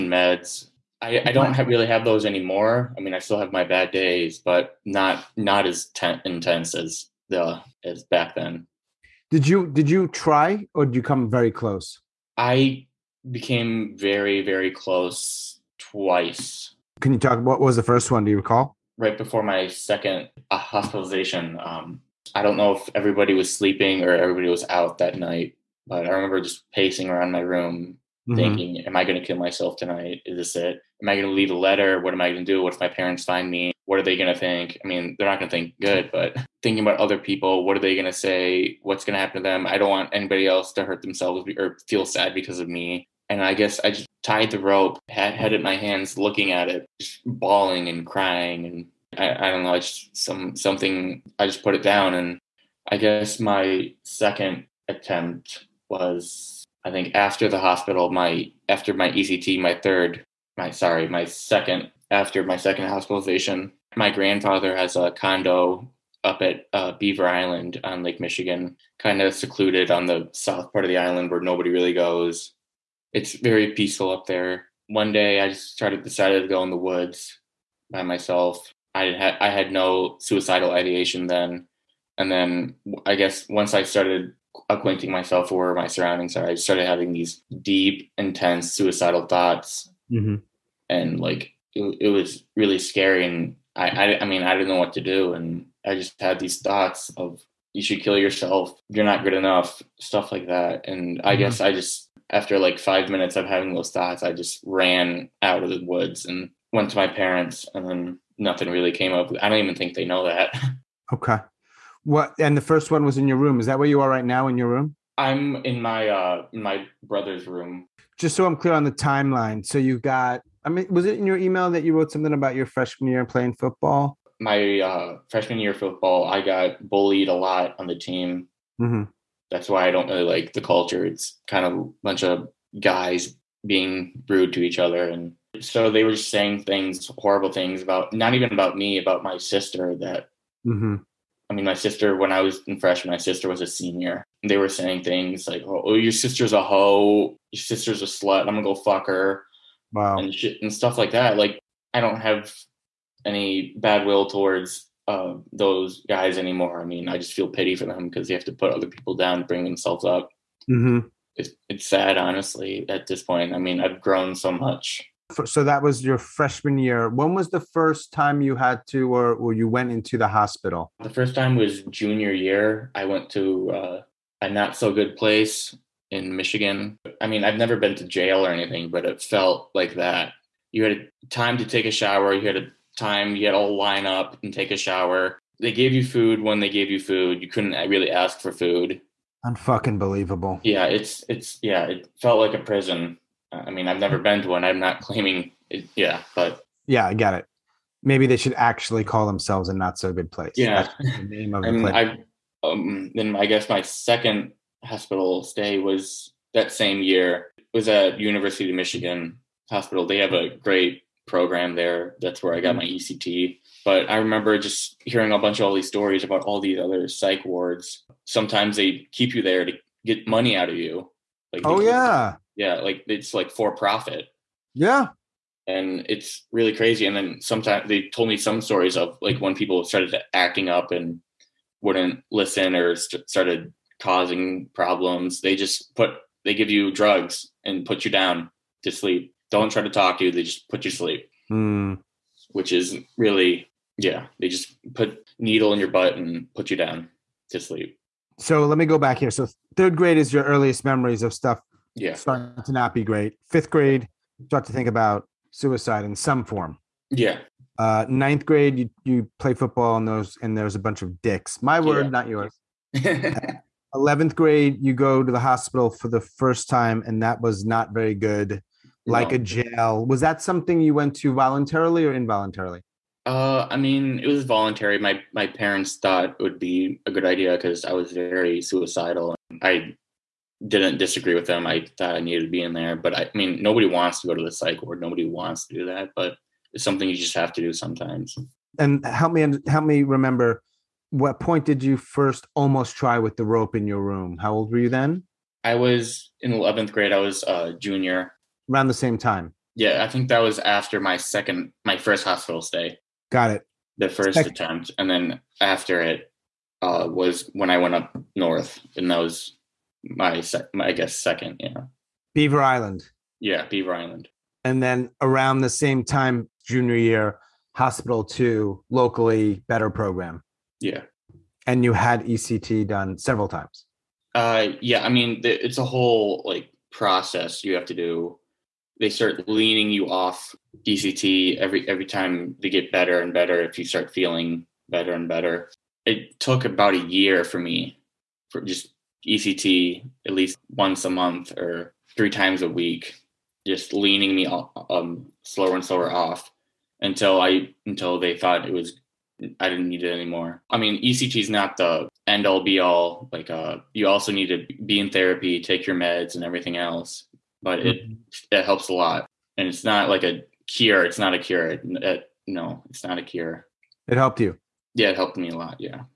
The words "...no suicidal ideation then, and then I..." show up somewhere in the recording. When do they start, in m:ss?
1:19.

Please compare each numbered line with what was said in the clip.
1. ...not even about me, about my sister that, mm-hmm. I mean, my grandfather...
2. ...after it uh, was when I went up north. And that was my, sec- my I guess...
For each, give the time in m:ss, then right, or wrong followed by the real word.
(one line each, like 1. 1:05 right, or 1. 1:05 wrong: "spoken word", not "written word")
1. 2:18 wrong: "sister", not "grandfather"
2. 5:05 right.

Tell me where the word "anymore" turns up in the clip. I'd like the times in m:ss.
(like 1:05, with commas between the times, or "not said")
0:02, 2:36, 5:50.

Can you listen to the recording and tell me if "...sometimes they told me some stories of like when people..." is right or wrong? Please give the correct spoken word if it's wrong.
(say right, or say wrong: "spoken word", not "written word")
right.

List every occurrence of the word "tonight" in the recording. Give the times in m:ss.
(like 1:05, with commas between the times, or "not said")
0:29.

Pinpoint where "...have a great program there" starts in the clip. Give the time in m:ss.
3:30.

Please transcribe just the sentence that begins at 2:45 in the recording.
So that was your freshman year.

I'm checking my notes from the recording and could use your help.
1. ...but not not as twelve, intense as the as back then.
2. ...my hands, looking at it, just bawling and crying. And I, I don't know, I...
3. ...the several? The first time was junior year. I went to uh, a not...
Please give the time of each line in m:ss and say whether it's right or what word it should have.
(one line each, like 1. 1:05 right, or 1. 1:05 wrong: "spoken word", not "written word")
1. 0:04 wrong: "ten", not "twelve"
2. 0:45 right
3. 2:50 wrong: "hospital", not "several".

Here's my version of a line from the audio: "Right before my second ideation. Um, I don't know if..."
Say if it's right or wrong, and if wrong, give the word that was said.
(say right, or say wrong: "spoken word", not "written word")
wrong: "hospitalization", not "ideation".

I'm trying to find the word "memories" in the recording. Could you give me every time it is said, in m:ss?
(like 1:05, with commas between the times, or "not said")
4:10.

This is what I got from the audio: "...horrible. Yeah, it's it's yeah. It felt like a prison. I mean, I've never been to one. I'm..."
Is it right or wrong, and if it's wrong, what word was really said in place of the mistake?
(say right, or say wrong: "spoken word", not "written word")
wrong: "believable", not "horrible".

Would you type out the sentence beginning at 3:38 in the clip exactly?
Sometimes they keep you there to get money out of you.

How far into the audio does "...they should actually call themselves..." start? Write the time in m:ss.
3:18.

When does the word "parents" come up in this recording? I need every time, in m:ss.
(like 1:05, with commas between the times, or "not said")
0:32, 1:47, 4:35.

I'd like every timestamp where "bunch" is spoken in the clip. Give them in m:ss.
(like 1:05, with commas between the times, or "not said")
2:12, 3:35, 4:20.